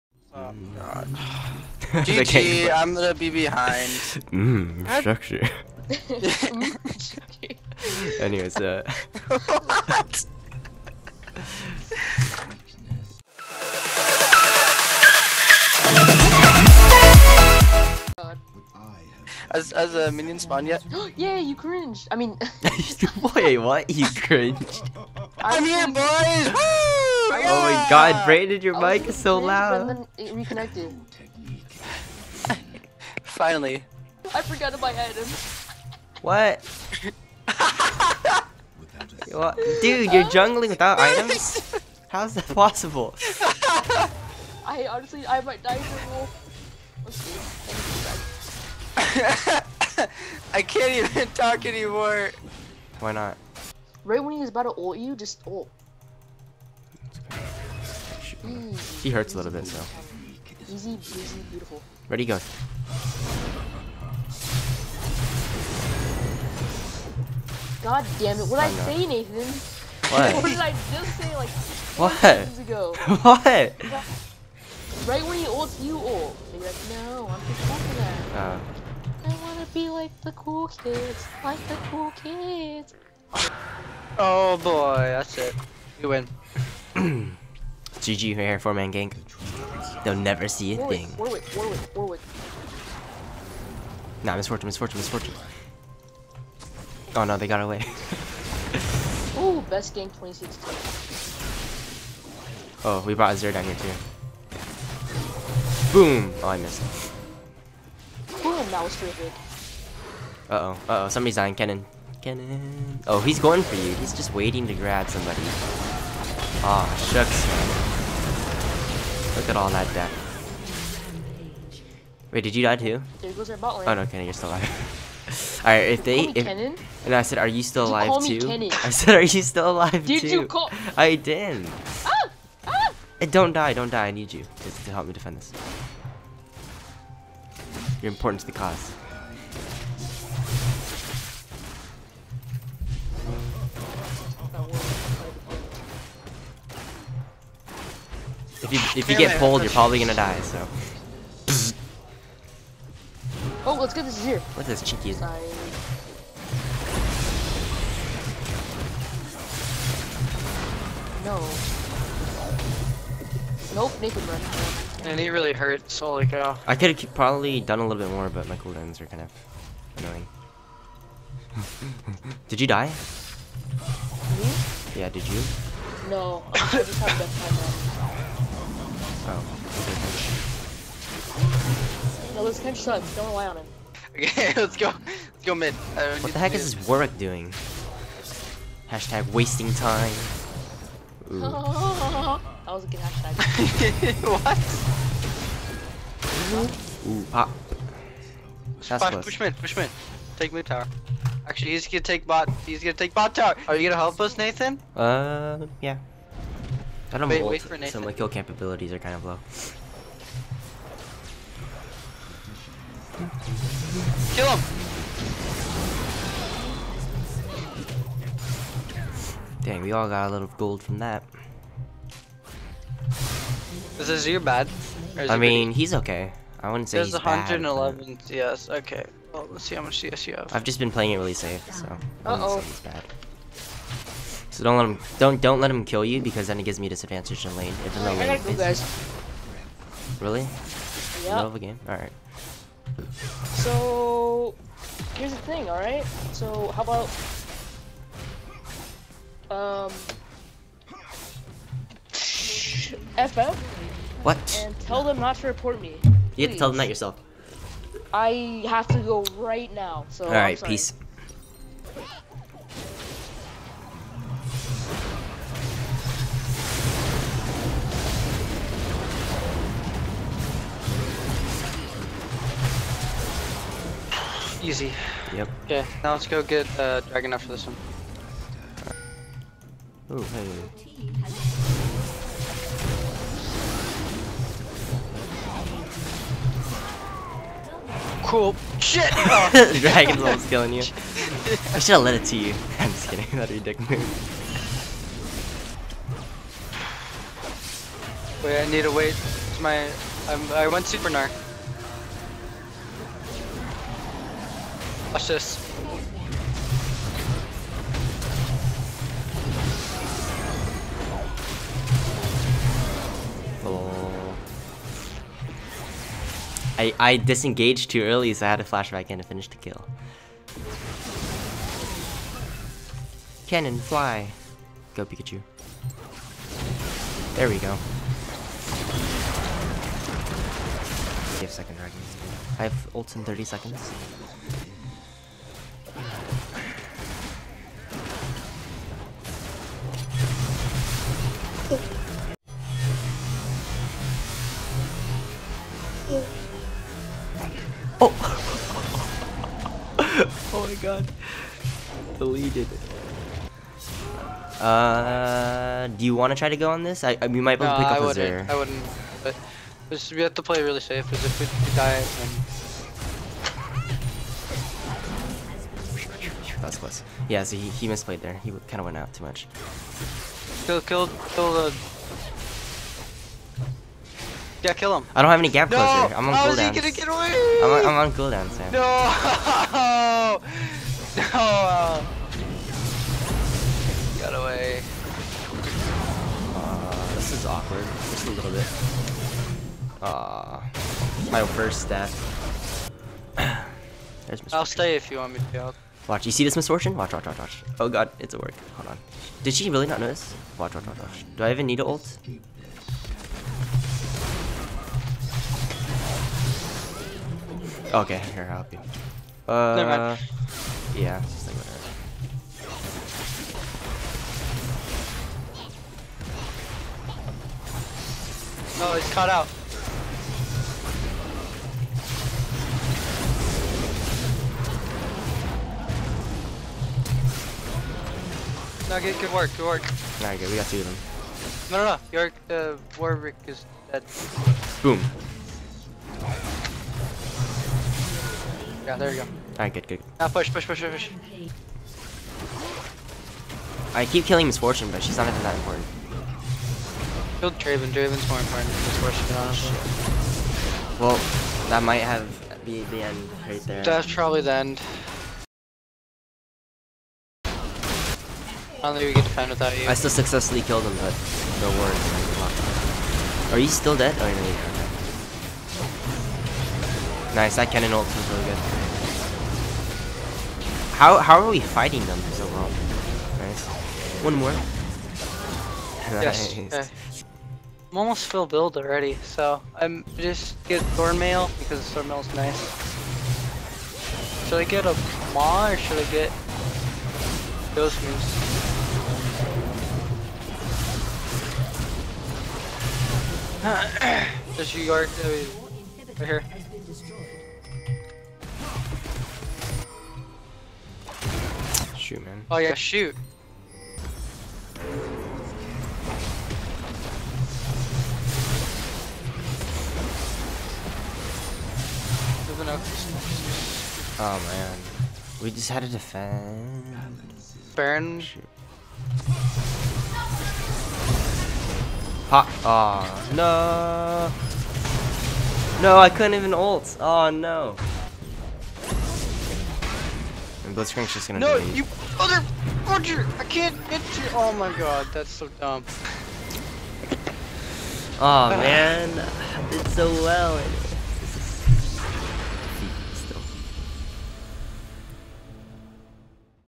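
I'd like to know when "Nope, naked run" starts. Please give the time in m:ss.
2:43.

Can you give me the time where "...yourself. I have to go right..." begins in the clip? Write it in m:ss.
4:16.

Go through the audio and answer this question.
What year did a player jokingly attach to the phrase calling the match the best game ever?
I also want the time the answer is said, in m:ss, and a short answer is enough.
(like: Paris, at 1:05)
2016, at 1:40.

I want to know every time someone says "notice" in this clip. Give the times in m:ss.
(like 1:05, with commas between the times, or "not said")
6:39.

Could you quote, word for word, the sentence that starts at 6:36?
Watch, you see this Miss Fortune?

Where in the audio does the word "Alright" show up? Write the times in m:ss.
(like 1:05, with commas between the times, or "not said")
2:05, 7:10, 7:19.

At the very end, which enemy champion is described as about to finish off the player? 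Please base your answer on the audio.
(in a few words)
Blitzcrank.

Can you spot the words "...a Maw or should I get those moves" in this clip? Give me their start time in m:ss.
8:04.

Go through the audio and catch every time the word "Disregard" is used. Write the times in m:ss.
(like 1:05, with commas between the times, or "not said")
8:14.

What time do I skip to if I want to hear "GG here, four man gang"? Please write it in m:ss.
1:27.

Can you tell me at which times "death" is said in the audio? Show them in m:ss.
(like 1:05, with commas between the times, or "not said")
1:59, 6:31.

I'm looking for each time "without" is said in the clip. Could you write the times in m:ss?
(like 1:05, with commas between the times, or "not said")
0:40, 7:39.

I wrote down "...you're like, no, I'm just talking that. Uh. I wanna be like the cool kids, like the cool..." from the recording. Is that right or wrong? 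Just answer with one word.
right.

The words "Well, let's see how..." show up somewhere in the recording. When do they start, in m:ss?
3:49.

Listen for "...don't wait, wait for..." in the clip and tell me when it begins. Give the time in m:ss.
3:27.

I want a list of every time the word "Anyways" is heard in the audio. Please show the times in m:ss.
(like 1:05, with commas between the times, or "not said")
0:08.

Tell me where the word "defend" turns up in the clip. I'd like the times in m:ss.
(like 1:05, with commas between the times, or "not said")
2:15, 8:35.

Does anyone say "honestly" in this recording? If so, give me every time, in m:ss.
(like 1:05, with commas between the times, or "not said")
0:44, 7:29.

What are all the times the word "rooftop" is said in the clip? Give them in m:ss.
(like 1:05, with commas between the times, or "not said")
not said.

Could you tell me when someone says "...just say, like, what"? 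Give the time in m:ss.
1:10.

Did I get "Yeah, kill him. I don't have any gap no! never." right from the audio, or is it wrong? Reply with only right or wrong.
wrong.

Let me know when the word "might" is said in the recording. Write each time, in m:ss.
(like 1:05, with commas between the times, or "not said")
0:45, 5:57, 7:31.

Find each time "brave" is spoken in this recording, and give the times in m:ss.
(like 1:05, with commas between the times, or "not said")
not said.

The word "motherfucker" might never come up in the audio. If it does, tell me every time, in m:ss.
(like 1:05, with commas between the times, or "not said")
8:51.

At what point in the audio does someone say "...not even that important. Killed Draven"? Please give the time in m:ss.
7:25.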